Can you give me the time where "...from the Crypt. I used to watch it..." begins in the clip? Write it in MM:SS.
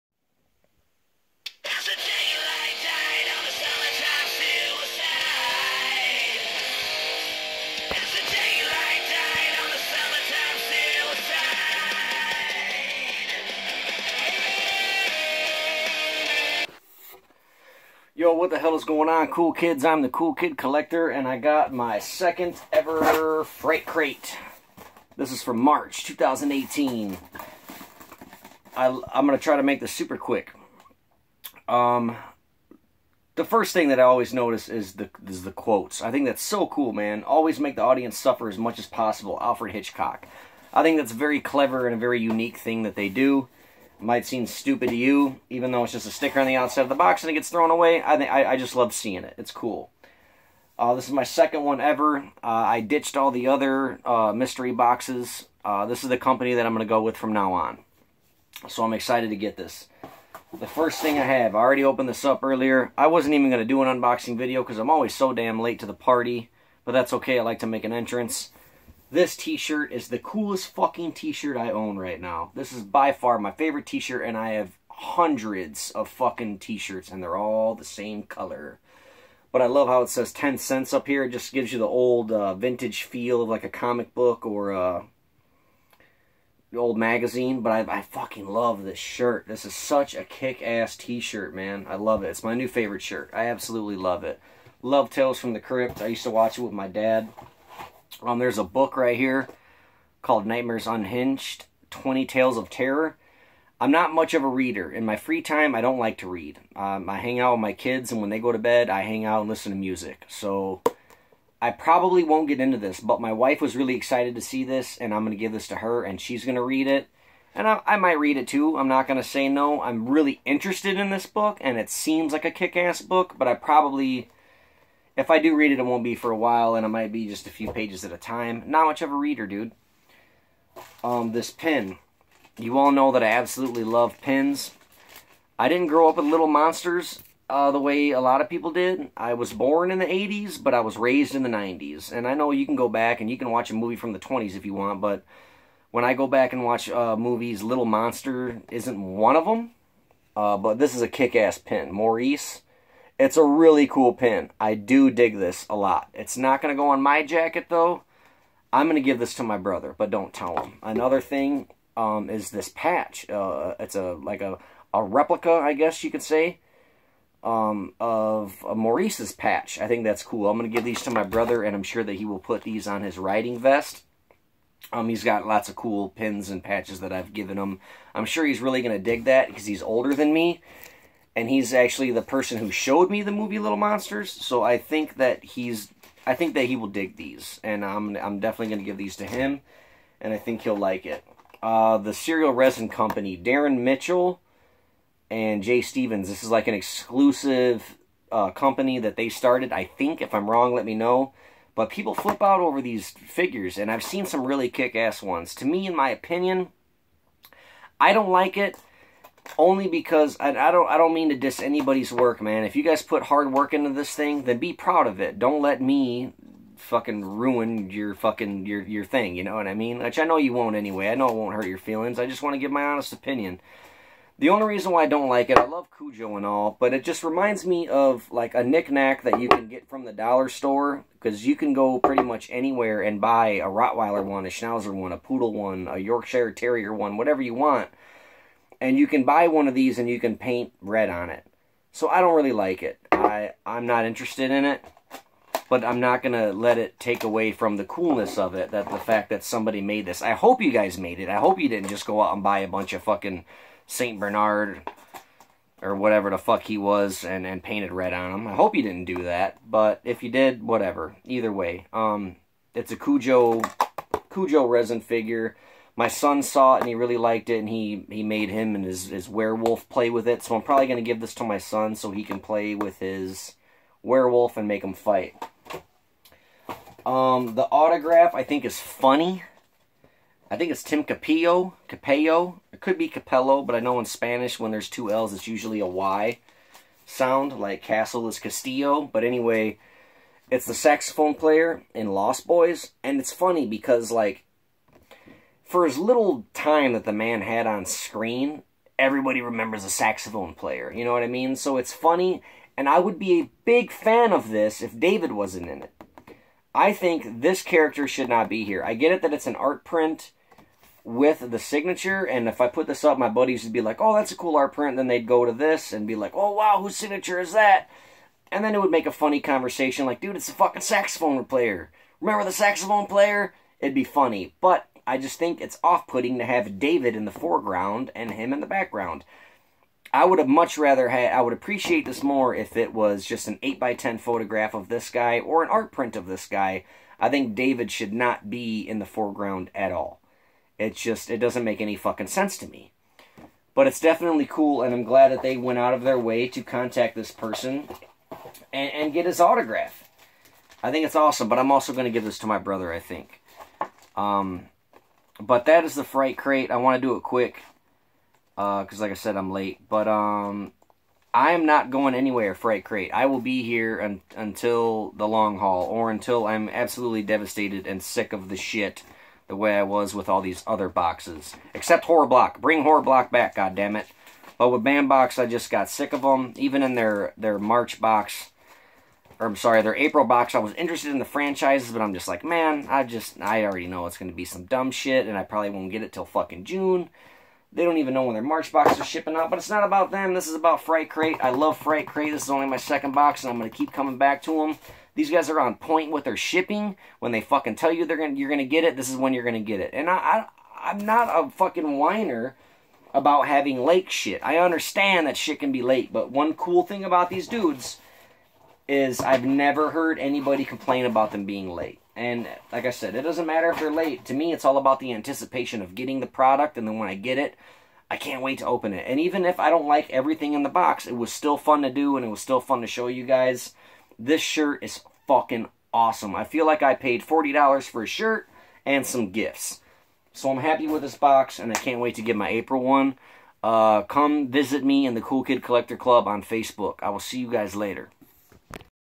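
01:35.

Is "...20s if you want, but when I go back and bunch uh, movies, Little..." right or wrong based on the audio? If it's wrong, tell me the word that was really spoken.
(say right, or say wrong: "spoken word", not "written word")
wrong: "watch", not "bunch".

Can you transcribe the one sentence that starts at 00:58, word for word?
So I'm excited to get this.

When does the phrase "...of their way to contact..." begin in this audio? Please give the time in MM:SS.
05:45.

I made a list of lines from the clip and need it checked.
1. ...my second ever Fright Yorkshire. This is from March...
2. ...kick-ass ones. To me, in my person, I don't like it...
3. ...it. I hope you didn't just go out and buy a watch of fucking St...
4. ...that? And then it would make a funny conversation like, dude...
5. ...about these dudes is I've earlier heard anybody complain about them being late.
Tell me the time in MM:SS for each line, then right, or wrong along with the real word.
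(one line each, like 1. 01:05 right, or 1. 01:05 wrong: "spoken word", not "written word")
1. 00:21 wrong: "Crate", not "Yorkshire"
2. 03:24 wrong: "opinion", not "person"
3. 04:11 wrong: "bunch", not "watch"
4. 05:17 right
5. 06:47 wrong: "never", not "earlier".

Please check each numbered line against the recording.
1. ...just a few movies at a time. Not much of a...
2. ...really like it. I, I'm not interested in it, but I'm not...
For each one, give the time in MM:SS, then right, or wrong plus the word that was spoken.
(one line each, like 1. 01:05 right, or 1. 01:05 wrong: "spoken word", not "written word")
1. 02:07 wrong: "pages", not "movies"
2. 04:02 right.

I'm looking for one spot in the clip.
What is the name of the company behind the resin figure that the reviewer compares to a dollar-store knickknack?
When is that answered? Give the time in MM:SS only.
03:12.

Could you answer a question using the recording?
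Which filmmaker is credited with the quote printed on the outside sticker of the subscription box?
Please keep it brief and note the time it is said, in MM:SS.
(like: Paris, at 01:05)
Alfred Hitchcock, at 00:39.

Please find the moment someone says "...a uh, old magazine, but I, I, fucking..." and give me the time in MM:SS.
01:24.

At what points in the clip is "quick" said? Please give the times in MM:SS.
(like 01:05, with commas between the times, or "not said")
00:30, 05:57.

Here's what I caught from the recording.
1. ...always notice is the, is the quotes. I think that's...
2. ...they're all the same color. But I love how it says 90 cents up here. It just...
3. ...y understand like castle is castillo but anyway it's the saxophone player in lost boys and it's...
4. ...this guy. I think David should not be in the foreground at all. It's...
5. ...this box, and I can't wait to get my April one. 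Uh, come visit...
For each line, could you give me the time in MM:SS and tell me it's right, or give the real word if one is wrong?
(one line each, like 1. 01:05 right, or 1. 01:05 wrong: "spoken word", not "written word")
1. 00:34 right
2. 01:17 wrong: "10", not "90"
3. 04:45 wrong: "sound", not "understand"
4. 05:36 right
5. 07:11 right.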